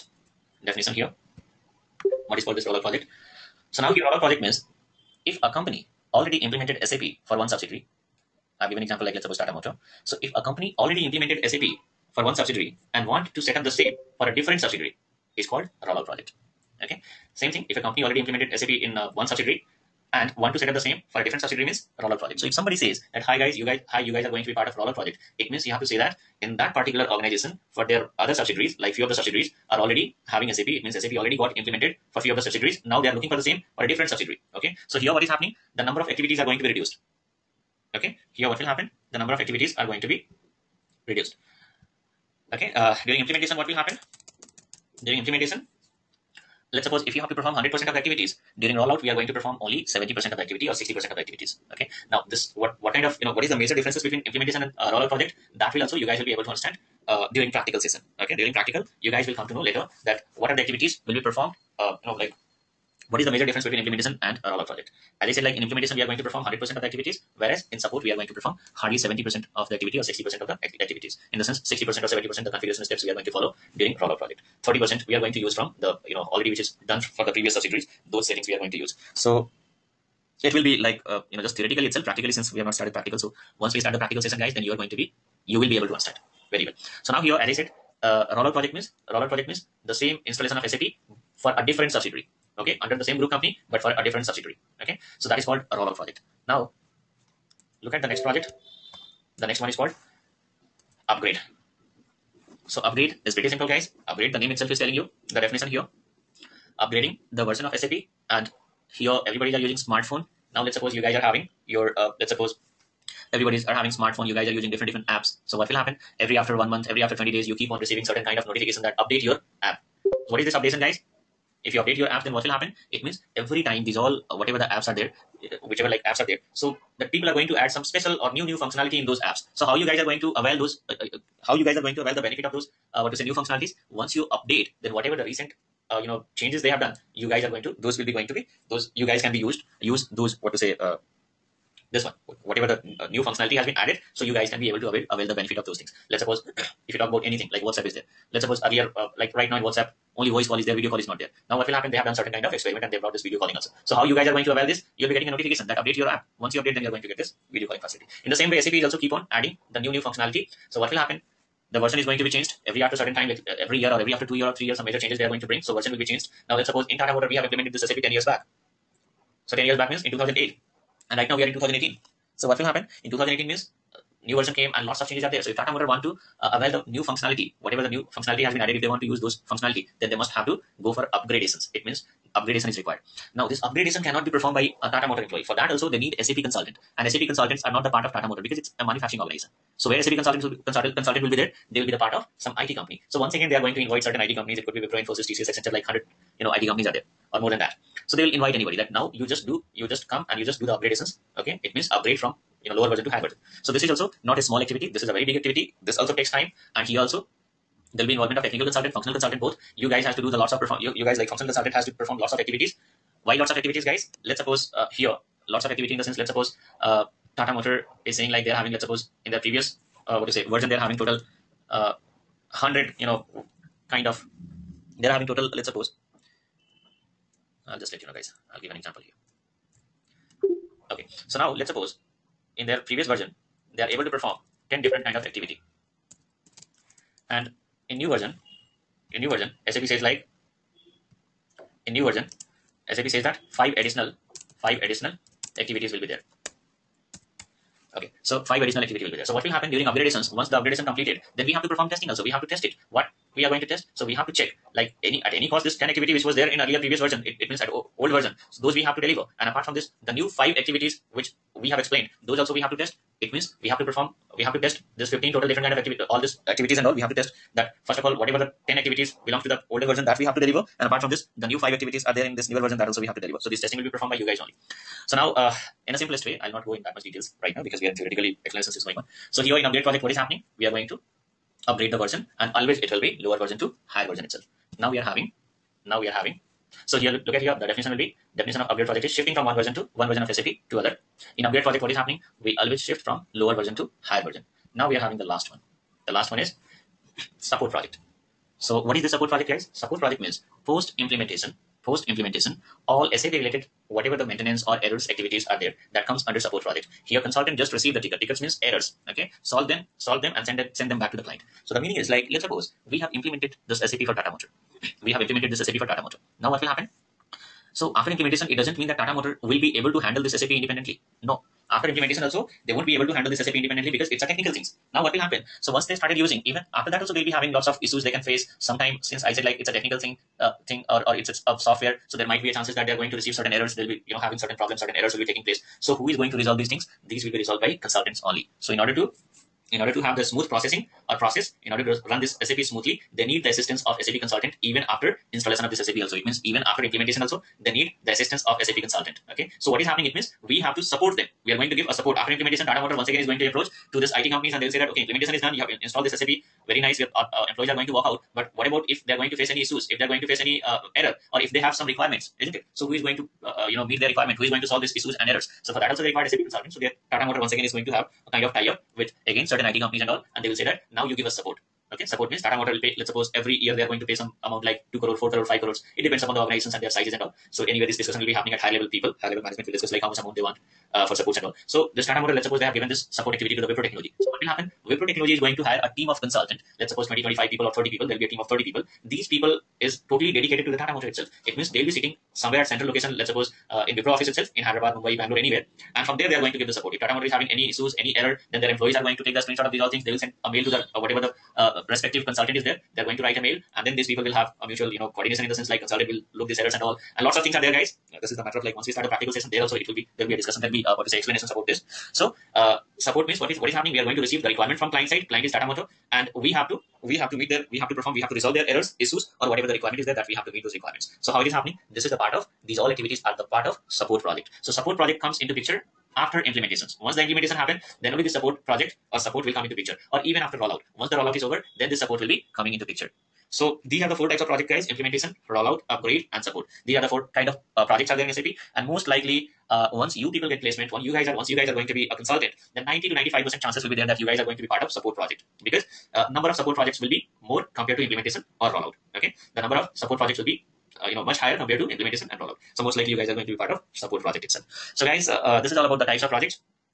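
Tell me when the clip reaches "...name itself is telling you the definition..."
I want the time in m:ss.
1:44.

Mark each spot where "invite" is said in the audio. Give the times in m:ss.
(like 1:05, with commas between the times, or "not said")
3:13, 3:18.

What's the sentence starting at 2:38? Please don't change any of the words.
In the same way, SAP is also keep on adding the new new functionality.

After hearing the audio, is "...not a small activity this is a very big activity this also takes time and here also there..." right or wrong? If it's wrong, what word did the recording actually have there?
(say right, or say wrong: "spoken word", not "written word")
right.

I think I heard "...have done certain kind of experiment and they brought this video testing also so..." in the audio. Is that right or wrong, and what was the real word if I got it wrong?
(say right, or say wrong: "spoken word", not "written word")
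wrong: "calling", not "testing".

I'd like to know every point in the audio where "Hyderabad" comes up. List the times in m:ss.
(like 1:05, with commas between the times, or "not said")
6:34.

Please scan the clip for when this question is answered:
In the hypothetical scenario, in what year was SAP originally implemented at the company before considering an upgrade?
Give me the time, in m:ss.
2:50.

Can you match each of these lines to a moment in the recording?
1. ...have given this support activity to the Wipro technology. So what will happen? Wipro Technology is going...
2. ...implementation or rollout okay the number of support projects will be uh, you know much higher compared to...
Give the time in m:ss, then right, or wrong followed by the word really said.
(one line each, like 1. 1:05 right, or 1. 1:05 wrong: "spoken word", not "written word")
1. 6:22 right
2. 7:28 right.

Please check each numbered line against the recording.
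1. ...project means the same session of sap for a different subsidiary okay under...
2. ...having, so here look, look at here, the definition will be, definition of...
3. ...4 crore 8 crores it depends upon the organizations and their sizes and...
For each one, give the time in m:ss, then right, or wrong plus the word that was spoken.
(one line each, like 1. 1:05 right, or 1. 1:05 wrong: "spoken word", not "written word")
1. 1:29 wrong: "installation", not "session"
2. 4:46 right
3. 6:15 wrong: "5", not "8".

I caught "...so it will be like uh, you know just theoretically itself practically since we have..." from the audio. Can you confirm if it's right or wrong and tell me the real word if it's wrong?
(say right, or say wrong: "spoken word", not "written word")
right.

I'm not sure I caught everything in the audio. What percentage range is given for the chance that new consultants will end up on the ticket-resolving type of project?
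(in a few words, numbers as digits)
90 to 95 percent.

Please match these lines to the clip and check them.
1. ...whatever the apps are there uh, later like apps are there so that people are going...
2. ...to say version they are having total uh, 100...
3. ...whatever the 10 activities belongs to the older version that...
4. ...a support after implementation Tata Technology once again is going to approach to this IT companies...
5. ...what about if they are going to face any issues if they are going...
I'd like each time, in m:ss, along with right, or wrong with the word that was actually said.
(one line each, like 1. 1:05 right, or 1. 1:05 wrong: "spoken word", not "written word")
1. 2:04 wrong: "whichever", not "later"
2. 3:40 right
3. 4:28 right
4. 5:51 wrong: "Motor", not "Technology"
5. 5:58 right.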